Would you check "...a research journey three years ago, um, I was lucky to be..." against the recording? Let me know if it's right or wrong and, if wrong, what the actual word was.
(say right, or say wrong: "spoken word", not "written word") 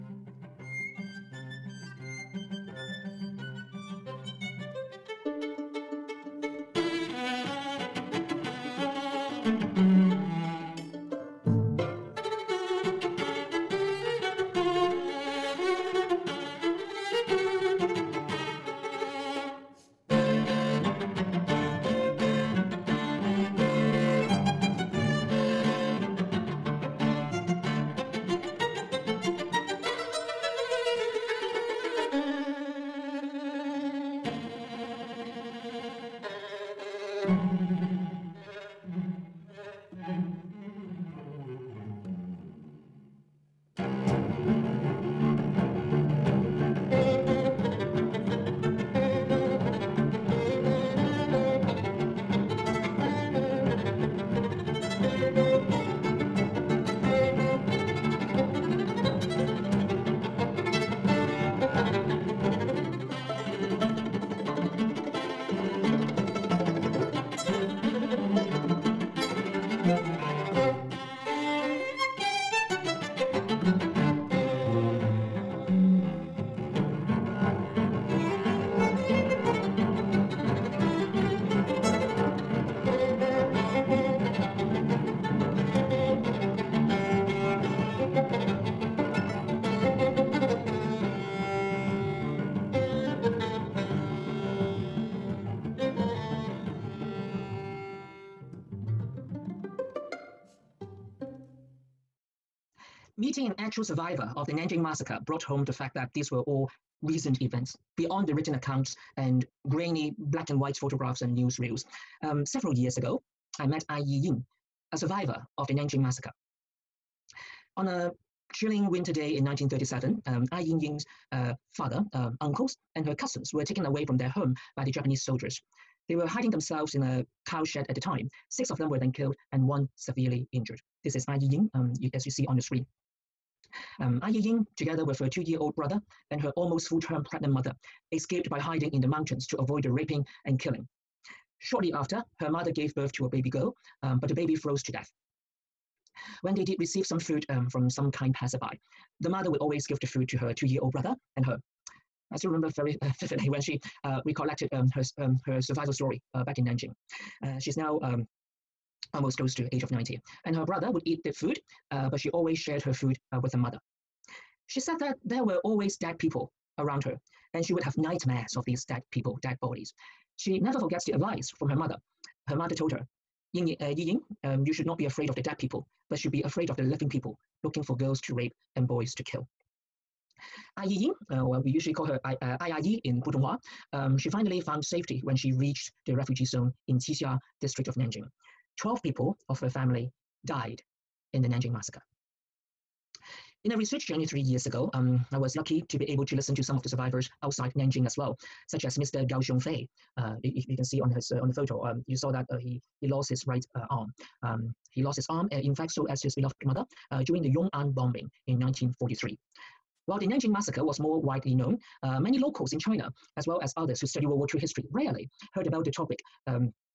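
right.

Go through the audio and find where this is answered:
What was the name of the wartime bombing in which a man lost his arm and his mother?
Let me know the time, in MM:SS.
03:27.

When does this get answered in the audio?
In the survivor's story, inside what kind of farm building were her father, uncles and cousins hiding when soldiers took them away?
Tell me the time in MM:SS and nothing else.
02:07.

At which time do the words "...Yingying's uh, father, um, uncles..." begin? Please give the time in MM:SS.
02:00.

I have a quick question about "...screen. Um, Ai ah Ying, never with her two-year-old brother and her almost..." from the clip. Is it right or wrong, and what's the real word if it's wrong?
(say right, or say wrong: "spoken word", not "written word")
wrong: "together", not "never".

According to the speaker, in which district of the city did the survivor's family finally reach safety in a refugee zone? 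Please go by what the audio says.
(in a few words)
Qixia district.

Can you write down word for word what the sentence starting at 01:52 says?
Um, several years ago, I met Ai Ying, a survivor of the Nanjing massacre.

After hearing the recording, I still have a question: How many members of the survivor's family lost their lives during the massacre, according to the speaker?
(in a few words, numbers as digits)
12.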